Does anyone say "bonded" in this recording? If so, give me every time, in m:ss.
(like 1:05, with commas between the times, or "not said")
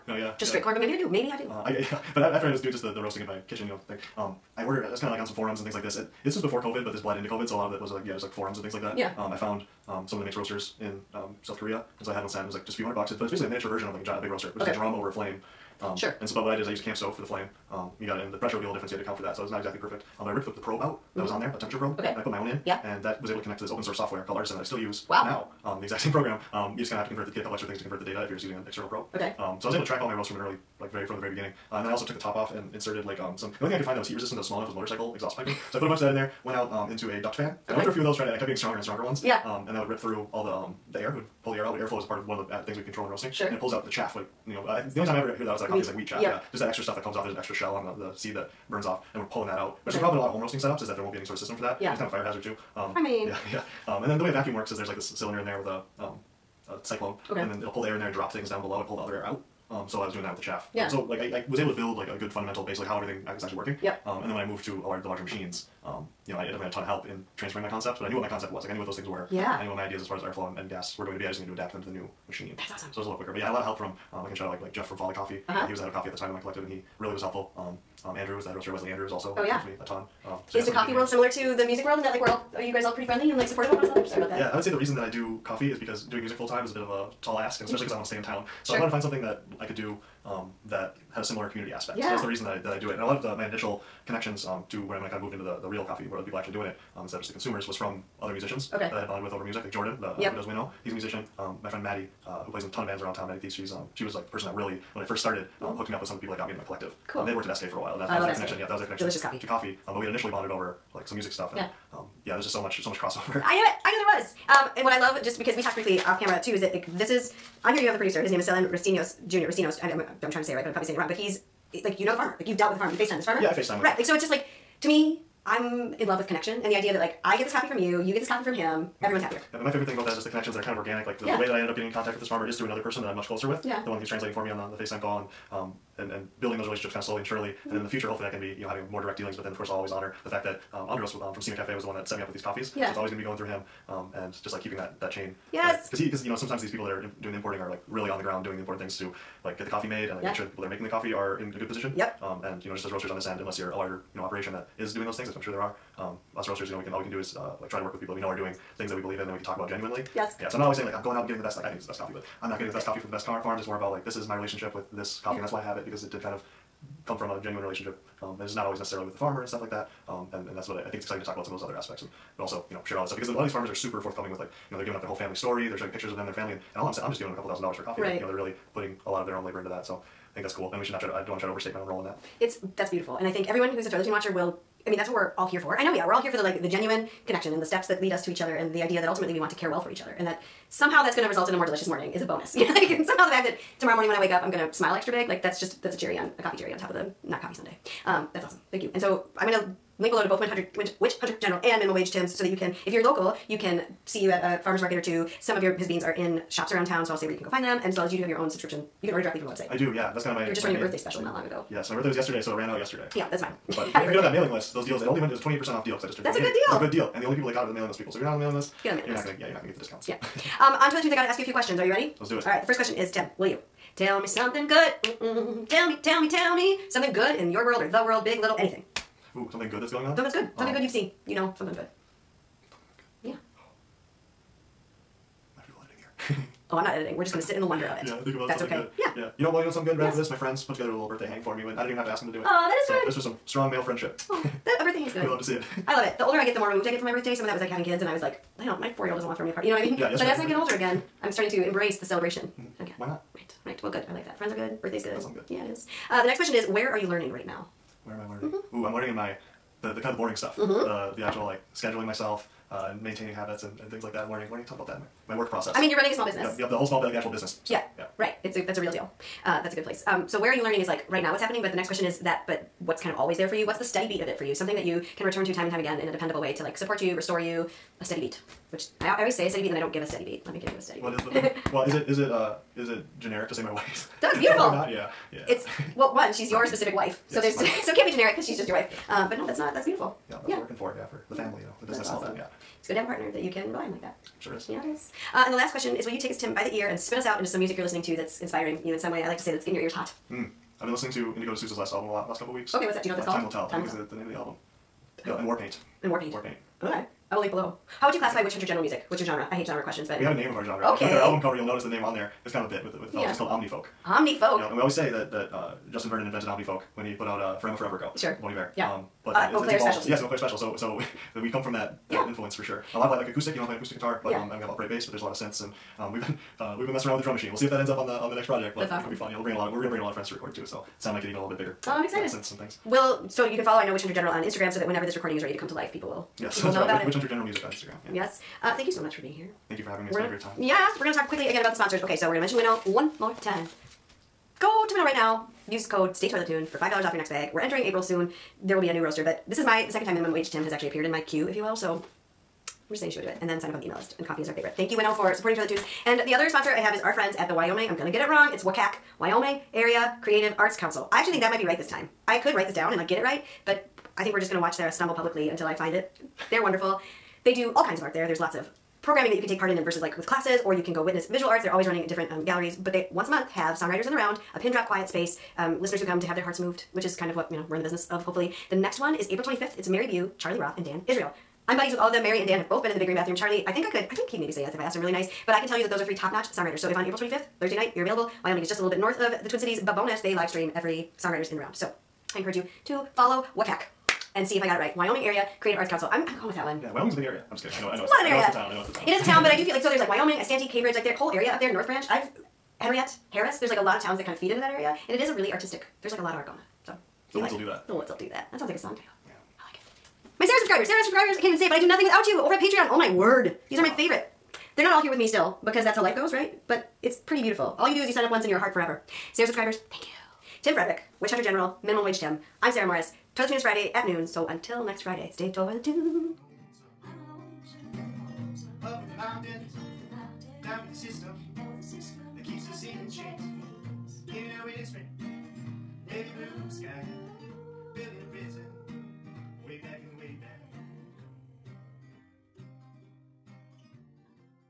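1:39, 1:50.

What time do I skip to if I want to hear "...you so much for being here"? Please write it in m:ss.
5:38.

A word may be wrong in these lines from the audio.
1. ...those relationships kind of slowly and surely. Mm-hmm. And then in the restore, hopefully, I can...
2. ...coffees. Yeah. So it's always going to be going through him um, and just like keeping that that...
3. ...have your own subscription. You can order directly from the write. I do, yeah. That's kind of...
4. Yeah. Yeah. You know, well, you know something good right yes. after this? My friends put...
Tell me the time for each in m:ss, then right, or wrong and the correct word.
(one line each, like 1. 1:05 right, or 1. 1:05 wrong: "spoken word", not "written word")
1. 2:16 wrong: "future", not "restore"
2. 2:22 right
3. 3:28 wrong: "website", not "write"
4. 3:59 right.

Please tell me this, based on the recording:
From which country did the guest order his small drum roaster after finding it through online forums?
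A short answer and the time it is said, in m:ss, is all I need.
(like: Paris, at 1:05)
South Korea, at 0:11.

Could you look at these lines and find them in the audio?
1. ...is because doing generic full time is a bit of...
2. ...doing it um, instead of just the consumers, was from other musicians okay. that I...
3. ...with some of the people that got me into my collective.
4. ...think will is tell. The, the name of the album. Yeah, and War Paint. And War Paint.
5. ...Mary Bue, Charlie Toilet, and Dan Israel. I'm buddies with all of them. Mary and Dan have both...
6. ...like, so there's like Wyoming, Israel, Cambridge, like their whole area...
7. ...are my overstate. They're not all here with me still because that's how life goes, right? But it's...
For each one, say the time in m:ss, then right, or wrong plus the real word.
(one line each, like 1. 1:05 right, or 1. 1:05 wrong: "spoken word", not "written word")
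1. 1:25 wrong: "music", not "generic"
2. 1:36 right
3. 1:46 right
4. 5:03 right
5. 6:19 wrong: "Roth", not "Toilet"
6. 6:39 wrong: "Isanti", not "Israel"
7. 6:53 wrong: "favorite", not "overstate".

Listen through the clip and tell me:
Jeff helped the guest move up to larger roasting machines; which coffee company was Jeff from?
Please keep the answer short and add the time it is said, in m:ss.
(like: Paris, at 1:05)
Folly Coffee, at 1:14.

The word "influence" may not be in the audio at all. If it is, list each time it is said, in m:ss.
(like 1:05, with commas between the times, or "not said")
5:22.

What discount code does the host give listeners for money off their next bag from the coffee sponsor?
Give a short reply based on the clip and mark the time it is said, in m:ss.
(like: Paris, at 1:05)
StayToiletTune, at 5:46.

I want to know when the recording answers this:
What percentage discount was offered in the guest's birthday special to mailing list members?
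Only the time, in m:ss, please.
3:35.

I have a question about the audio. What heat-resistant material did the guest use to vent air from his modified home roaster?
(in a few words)
Motorcycle exhaust piping.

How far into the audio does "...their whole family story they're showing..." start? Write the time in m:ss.
2:55.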